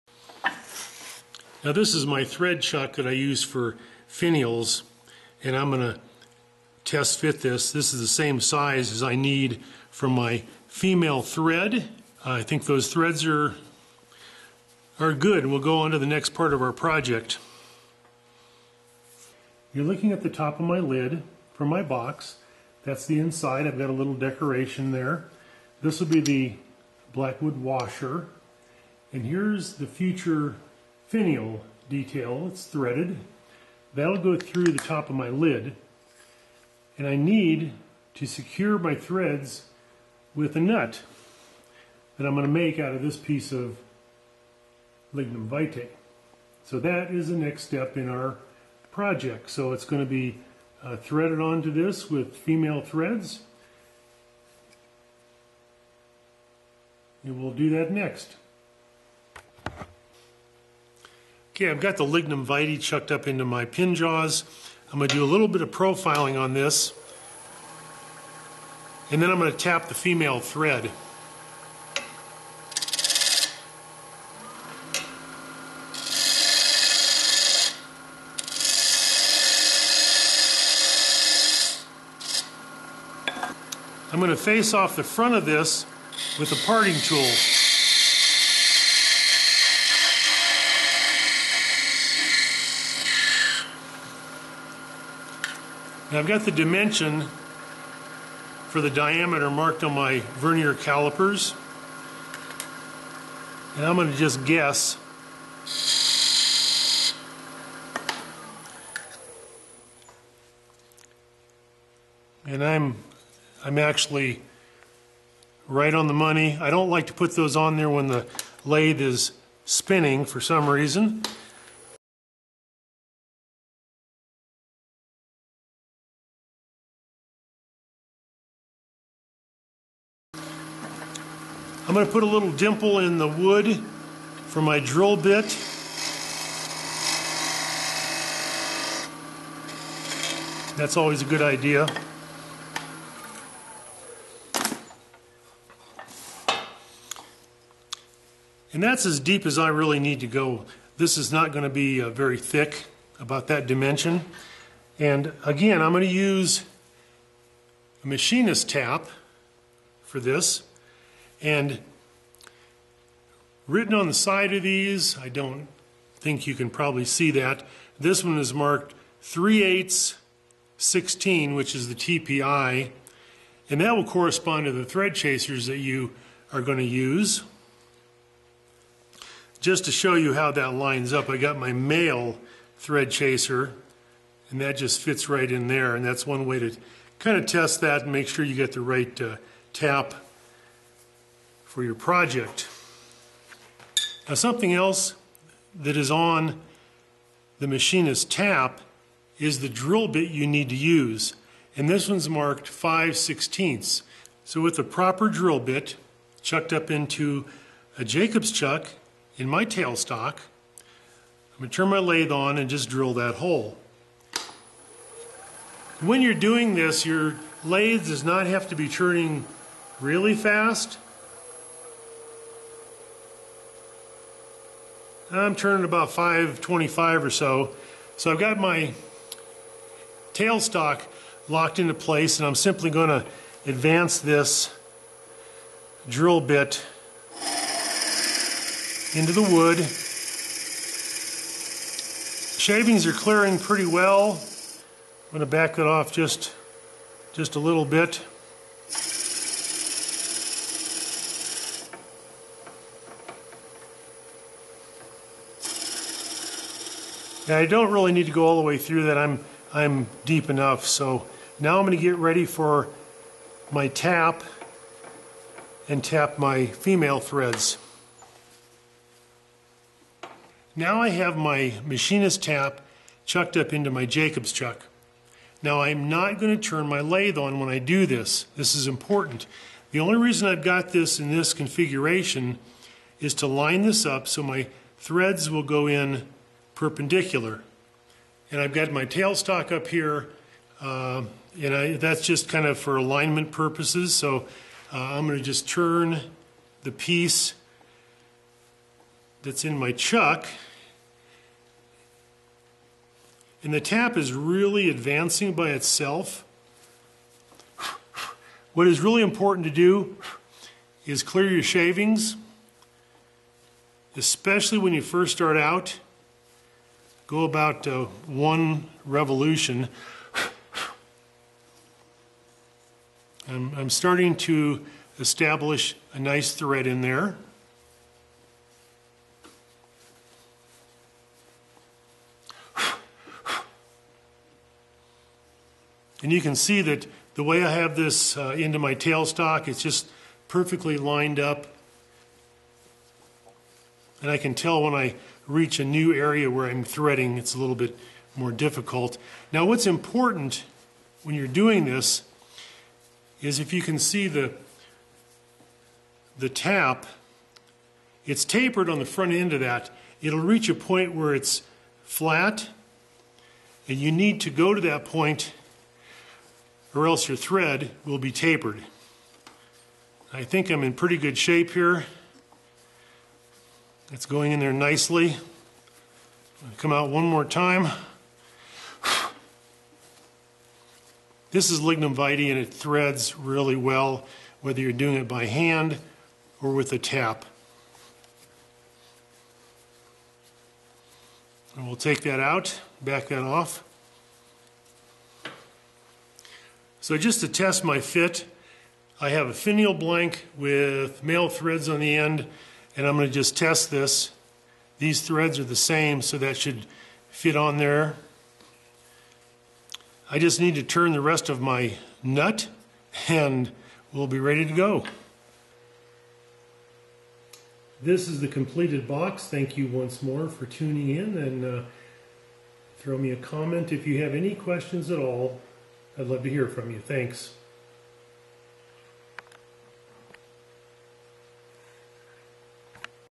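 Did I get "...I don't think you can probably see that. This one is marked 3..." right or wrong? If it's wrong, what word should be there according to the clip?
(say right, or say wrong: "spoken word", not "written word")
right.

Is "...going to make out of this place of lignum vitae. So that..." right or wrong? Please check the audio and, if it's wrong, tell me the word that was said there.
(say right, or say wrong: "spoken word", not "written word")
wrong: "piece", not "place".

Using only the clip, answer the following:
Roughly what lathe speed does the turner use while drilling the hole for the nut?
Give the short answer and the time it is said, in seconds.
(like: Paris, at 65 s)
525, at 226 s.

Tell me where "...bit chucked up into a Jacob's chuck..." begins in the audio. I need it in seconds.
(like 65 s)
205 s.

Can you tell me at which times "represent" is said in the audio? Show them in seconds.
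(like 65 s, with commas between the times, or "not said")
not said.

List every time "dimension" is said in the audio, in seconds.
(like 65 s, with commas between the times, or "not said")
96 s, 153 s.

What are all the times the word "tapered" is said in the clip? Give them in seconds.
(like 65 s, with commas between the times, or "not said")
358 s, 368 s.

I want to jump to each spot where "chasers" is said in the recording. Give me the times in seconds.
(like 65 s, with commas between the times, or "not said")
175 s, 183 s.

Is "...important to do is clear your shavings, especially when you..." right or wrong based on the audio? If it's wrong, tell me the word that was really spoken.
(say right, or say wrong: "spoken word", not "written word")
right.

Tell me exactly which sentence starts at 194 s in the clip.
Now, something else that is on the machinist tap is the drill bit you need to use.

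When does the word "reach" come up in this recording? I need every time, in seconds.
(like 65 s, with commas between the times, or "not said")
345 s, 360 s.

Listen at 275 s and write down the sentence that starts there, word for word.
Now I'm not going to turn my lathe on when I do this.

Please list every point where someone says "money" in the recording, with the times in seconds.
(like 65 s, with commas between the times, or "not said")
116 s.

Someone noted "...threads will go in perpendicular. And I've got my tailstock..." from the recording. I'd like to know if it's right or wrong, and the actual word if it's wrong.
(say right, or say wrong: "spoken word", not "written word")
right.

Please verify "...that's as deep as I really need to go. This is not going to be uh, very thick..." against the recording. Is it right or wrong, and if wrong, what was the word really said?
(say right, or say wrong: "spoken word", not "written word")
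right.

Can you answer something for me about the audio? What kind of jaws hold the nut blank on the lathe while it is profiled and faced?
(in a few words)
pin jaws.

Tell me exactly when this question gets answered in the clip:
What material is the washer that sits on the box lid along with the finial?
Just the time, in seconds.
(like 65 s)
27 s.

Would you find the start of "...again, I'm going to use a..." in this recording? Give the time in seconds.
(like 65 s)
155 s.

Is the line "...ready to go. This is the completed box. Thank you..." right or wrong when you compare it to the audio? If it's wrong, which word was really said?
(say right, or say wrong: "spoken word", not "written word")
right.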